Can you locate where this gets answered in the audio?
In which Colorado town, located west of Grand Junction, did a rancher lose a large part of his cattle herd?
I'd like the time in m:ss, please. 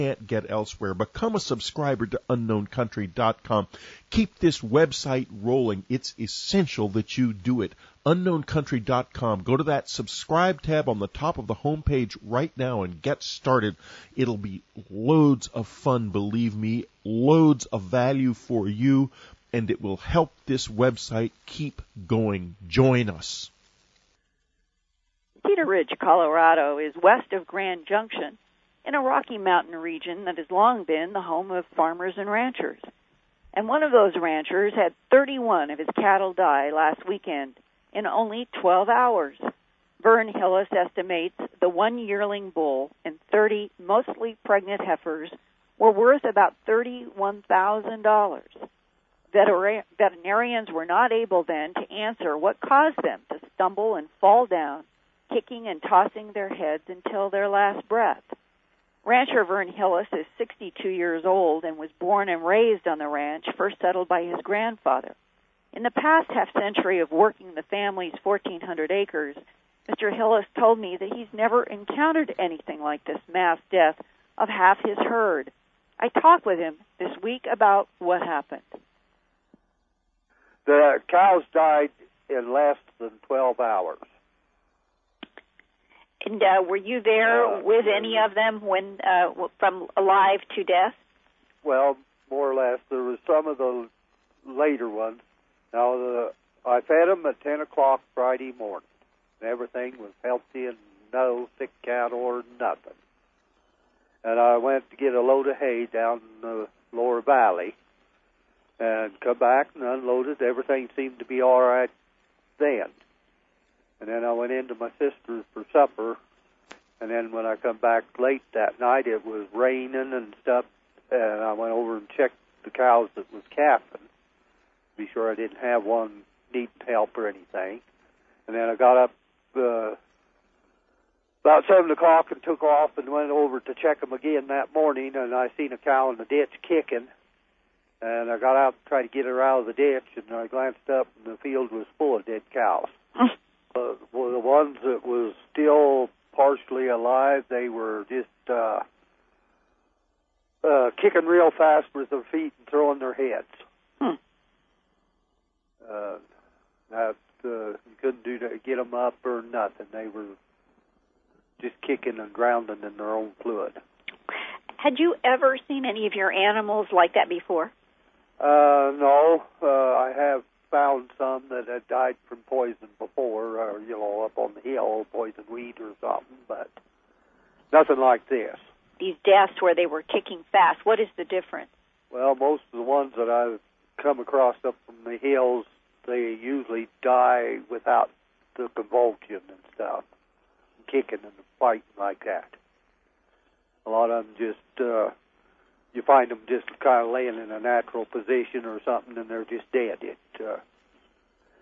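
0:25.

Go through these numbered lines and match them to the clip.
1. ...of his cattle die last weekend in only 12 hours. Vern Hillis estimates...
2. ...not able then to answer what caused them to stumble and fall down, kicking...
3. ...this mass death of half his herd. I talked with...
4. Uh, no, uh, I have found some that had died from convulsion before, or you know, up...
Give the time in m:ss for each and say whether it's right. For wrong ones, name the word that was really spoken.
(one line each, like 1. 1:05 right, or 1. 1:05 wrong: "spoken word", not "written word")
1. 0:35 right
2. 0:50 right
3. 1:13 right
4. 2:48 wrong: "poison", not "convulsion".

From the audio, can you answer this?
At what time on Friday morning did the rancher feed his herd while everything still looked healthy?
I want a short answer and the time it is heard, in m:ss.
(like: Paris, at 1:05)
10 o'clock, at 1:37.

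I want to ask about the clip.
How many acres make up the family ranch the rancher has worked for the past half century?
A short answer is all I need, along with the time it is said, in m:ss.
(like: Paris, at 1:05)
1,400, at 1:08.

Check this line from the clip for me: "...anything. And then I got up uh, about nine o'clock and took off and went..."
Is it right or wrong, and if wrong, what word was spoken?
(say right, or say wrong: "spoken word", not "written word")
wrong: "seven", not "nine".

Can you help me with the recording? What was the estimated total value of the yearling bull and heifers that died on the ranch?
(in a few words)
$31,000.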